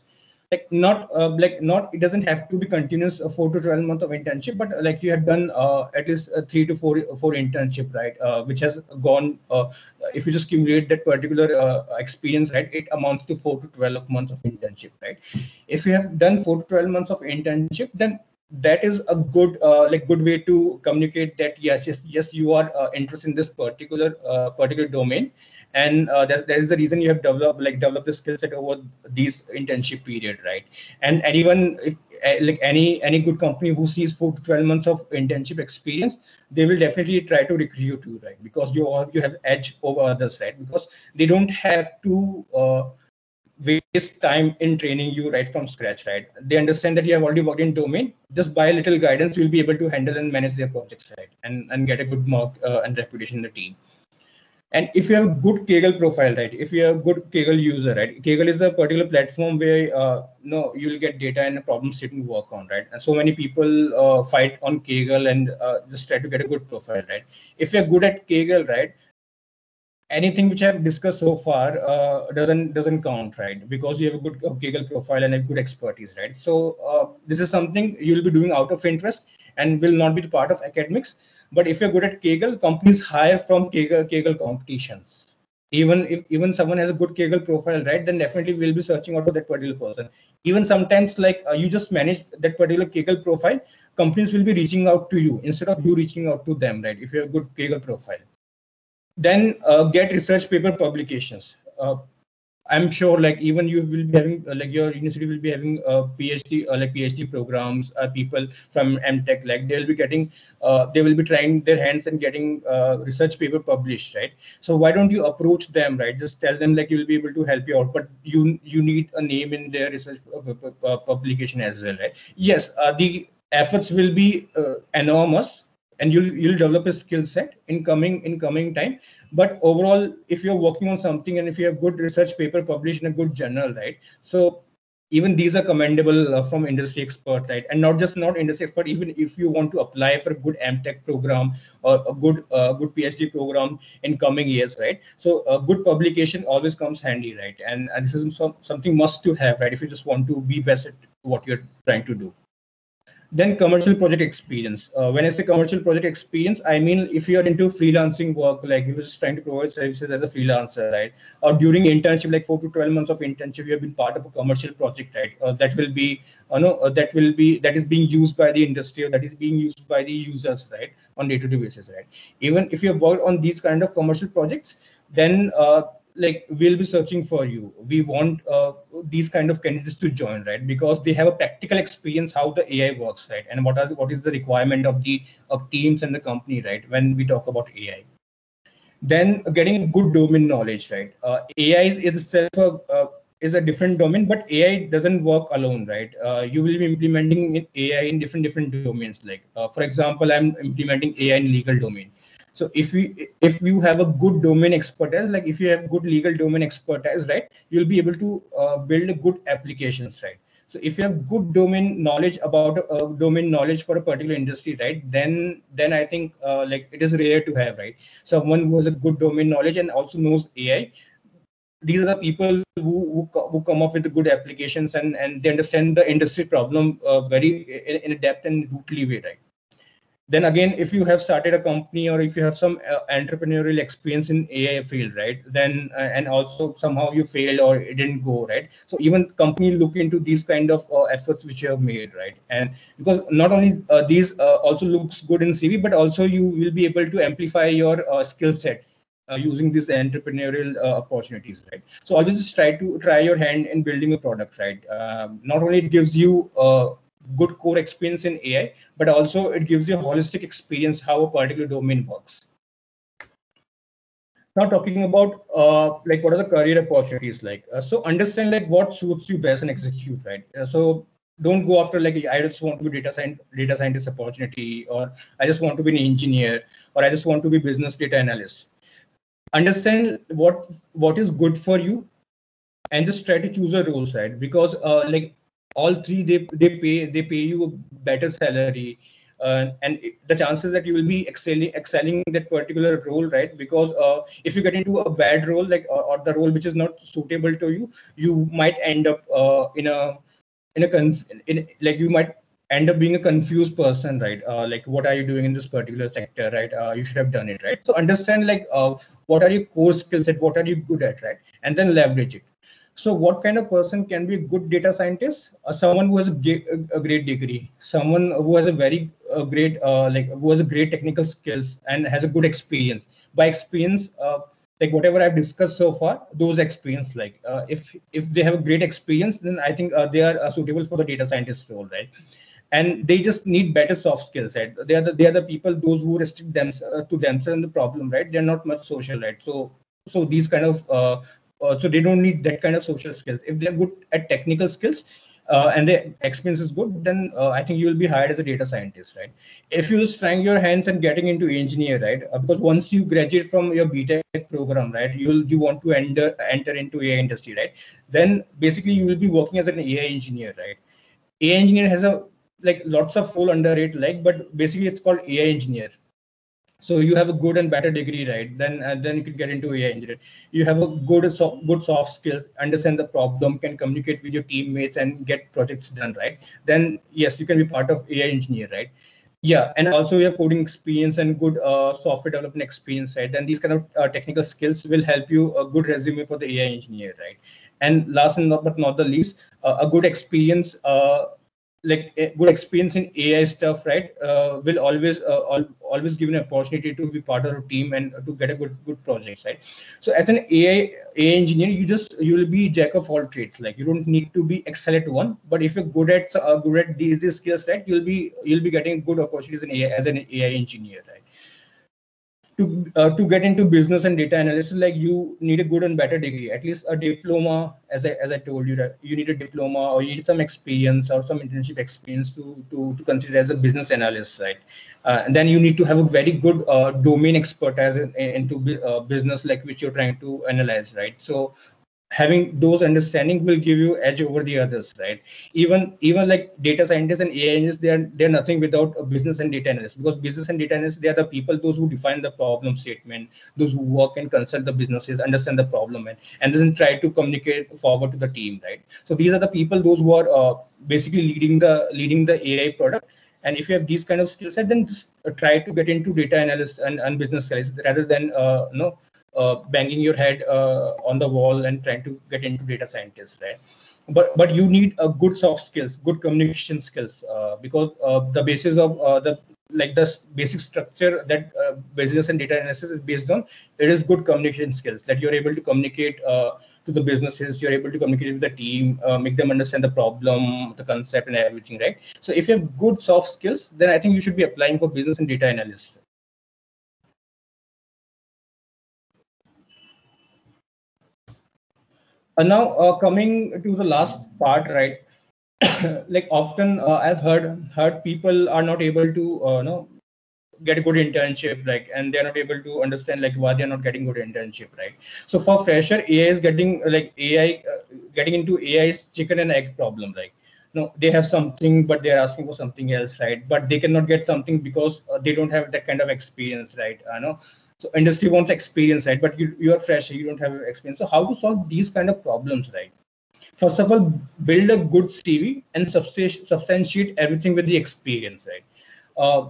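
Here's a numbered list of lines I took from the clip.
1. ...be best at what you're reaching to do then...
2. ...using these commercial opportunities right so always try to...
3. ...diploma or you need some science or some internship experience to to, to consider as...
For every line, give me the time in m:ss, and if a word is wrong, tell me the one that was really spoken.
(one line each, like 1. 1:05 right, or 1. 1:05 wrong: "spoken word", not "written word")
1. 2:30 wrong: "trying", not "reaching"
2. 4:09 wrong: "entrepreneurial", not "commercial"
3. 6:59 wrong: "experience", not "science".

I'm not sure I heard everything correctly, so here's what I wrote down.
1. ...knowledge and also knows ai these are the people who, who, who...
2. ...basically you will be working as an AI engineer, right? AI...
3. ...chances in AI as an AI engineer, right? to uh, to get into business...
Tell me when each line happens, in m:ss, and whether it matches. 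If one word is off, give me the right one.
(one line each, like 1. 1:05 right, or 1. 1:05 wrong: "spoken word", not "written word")
1. 3:39 right
2. 5:58 right
3. 6:49 wrong: "opportunities", not "chances".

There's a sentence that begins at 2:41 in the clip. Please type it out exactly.
Or during internship, like four to twelve months of internship, you have been part of a commercial project, right?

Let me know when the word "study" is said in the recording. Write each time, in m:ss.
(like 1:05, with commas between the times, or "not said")
not said.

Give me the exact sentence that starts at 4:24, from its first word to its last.
Now talking about uh, like what are the career opportunities like?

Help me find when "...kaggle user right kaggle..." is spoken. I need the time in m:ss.
0:57.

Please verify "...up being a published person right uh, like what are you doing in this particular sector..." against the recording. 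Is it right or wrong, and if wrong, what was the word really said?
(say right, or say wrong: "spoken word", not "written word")
wrong: "confused", not "published".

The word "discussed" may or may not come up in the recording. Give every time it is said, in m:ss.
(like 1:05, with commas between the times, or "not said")
1:10, 5:25.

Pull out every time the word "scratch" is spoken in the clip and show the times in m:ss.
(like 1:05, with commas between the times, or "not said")
0:45.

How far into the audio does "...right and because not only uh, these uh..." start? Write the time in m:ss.
4:02.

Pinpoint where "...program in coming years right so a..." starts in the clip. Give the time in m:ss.
2:23.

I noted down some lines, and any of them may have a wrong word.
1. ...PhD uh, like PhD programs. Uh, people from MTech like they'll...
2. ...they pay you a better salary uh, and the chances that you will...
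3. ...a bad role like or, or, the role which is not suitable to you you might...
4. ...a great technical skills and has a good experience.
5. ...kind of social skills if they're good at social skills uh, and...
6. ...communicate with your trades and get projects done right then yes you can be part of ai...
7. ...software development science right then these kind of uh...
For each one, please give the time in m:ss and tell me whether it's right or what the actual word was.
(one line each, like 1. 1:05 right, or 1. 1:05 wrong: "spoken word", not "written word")
1. 1:46 right
2. 4:47 right
3. 4:55 right
4. 5:20 right
5. 5:42 wrong: "technical", not "social"
6. 6:13 wrong: "teammates", not "trades"
7. 6:21 wrong: "experience", not "science".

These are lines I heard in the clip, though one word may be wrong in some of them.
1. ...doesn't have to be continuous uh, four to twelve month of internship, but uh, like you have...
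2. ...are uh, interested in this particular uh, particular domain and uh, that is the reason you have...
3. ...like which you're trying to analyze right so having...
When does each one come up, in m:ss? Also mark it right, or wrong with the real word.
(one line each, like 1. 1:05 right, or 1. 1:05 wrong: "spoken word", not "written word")
1. 0:01 right
2. 0:22 right
3. 7:09 right.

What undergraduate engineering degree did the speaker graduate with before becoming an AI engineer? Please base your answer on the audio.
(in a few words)
BTech.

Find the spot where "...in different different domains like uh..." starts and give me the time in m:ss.
3:18.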